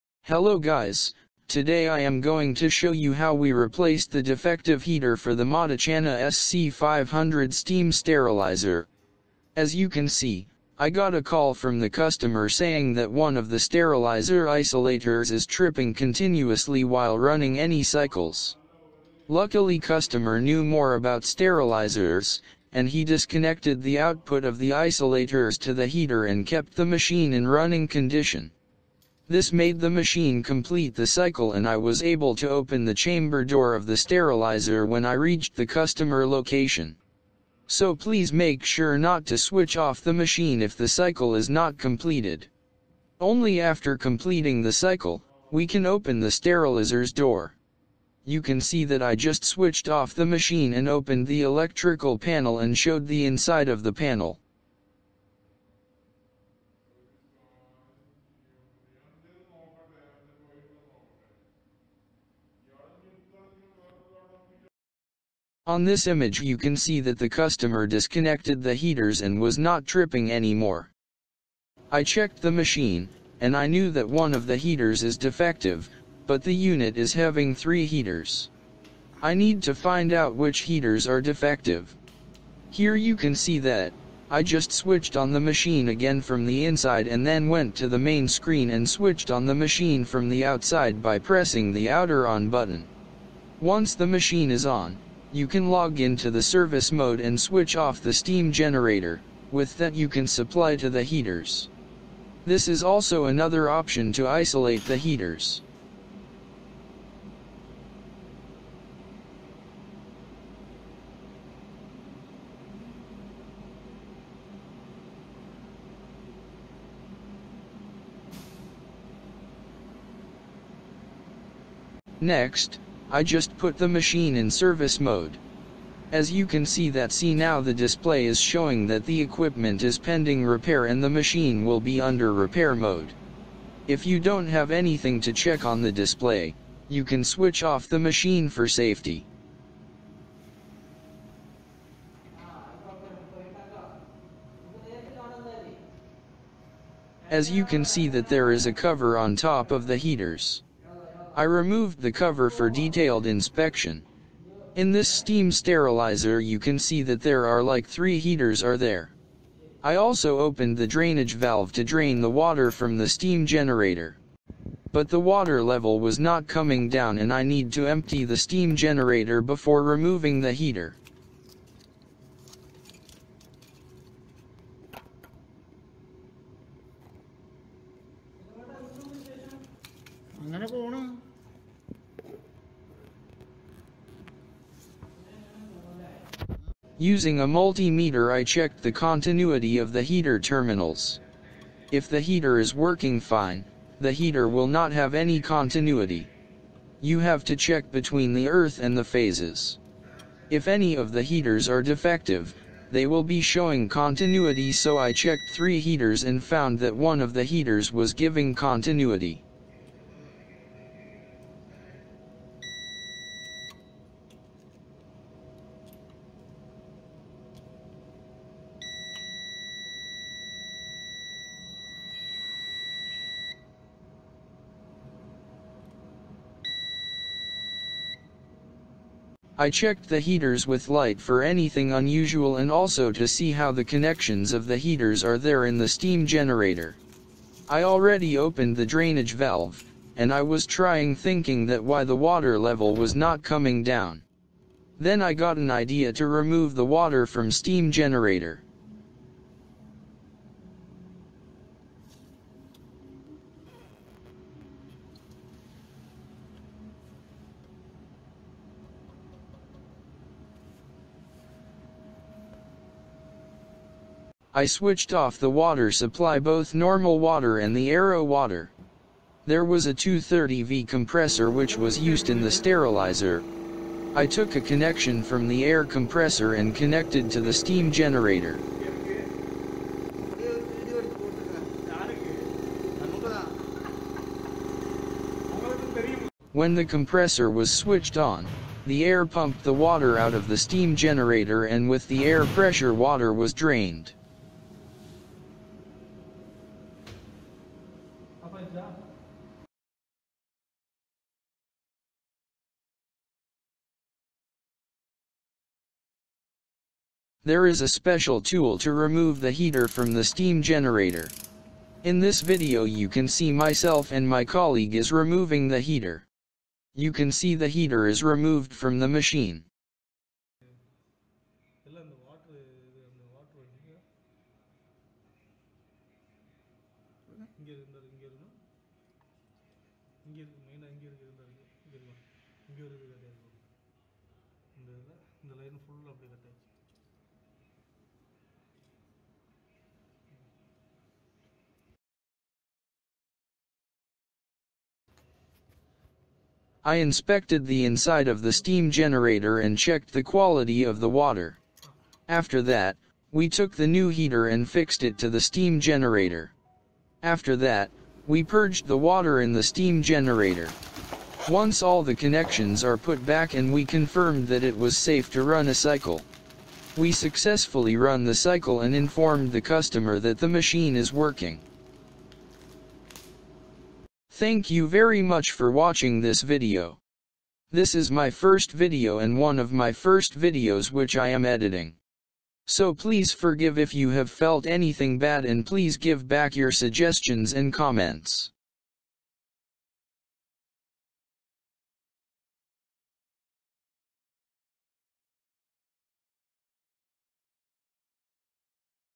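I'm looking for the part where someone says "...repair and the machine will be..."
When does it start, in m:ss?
2:10.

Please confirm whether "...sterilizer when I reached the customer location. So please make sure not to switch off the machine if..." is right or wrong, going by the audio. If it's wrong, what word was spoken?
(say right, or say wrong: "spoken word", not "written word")
right.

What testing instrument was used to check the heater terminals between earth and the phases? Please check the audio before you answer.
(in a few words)
multimeter.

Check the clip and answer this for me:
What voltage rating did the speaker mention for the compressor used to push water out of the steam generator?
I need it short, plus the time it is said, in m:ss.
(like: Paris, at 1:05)
230V, at 4:29.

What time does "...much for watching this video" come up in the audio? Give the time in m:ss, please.
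6:15.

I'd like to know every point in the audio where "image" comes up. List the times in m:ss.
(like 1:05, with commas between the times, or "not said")
1:06.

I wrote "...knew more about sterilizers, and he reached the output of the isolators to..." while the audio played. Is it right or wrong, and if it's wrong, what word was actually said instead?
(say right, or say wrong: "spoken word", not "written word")
wrong: "disconnected", not "reached".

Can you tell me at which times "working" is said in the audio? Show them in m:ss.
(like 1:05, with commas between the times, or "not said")
3:12, 6:11.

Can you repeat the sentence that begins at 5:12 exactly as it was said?
In this video you can see myself and my colleague is removing the heater.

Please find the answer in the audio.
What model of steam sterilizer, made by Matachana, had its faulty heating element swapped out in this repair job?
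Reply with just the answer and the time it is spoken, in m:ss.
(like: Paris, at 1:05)
SC500, at 0:06.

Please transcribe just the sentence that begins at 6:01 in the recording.
Once all the connections are put back and we confirmed that it was safe to run a cycle.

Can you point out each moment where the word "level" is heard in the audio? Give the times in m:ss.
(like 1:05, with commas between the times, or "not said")
2:45, 4:02.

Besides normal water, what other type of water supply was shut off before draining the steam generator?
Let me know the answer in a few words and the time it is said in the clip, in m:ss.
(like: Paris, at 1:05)
RO water, at 4:27.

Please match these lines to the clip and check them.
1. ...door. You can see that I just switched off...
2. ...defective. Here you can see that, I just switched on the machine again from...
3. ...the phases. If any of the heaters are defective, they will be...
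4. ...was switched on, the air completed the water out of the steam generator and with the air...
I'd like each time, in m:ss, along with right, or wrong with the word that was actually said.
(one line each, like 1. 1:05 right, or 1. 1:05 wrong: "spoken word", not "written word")
1. 0:47 right
2. 1:21 right
3. 3:18 right
4. 4:47 wrong: "pumped", not "completed".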